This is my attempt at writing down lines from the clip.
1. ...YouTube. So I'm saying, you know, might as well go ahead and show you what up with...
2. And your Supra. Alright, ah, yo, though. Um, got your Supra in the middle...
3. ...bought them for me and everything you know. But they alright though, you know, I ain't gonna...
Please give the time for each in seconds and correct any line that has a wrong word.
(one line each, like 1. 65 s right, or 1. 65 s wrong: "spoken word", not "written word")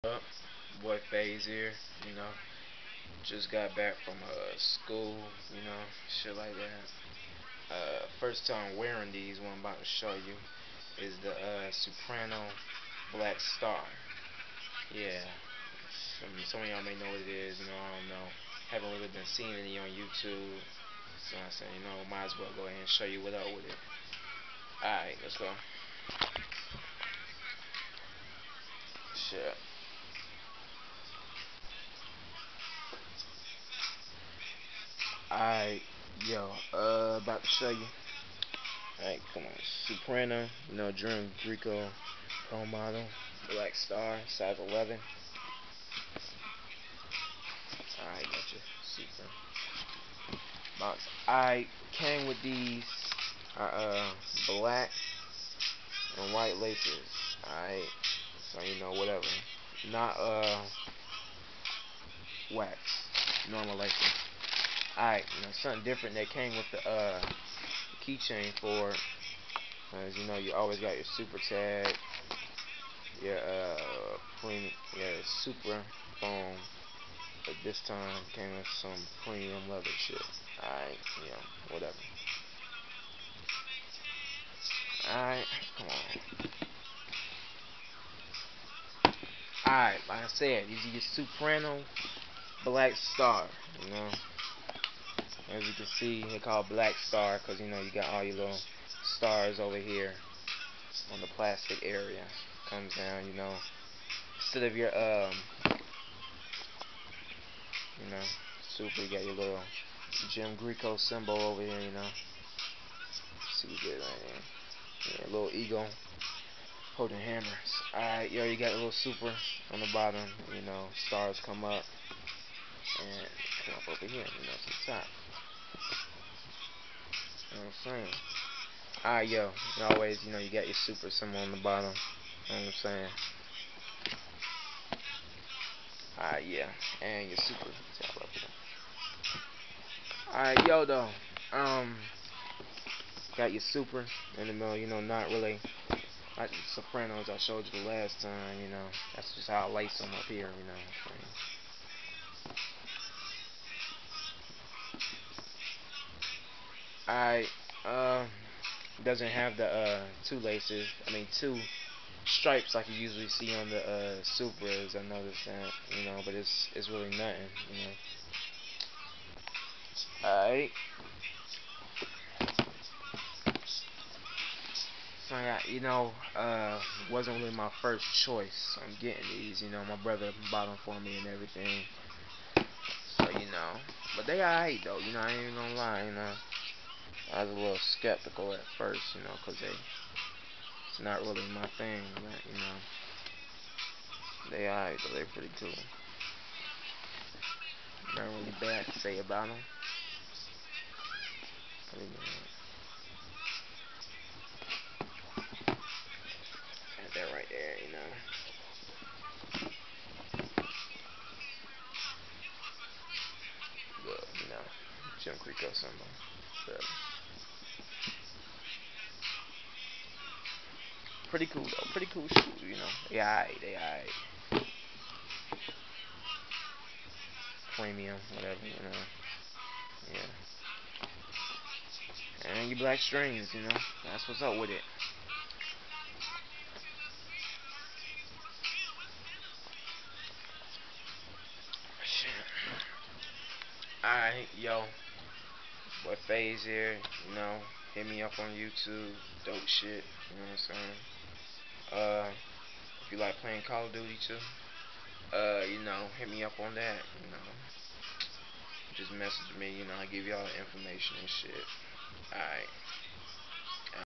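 1. 19 s right
2. 137 s right
3. 180 s right.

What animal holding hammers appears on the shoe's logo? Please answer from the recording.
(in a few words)
Eagle.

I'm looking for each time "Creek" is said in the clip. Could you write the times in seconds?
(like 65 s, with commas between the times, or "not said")
215 s.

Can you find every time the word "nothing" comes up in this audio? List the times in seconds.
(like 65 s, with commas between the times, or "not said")
167 s.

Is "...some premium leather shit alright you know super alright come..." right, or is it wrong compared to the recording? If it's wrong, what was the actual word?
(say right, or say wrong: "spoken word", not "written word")
wrong: "whatever", not "super".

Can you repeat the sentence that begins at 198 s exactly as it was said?
Not really bad to say about them.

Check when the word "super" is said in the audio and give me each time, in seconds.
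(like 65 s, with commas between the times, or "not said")
75 s, 113 s.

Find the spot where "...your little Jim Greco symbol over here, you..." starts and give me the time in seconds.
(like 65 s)
109 s.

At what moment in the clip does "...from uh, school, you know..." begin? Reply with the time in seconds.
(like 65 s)
4 s.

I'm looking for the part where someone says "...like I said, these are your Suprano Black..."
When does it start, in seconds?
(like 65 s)
90 s.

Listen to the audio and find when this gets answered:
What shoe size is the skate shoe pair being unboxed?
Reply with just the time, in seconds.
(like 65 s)
44 s.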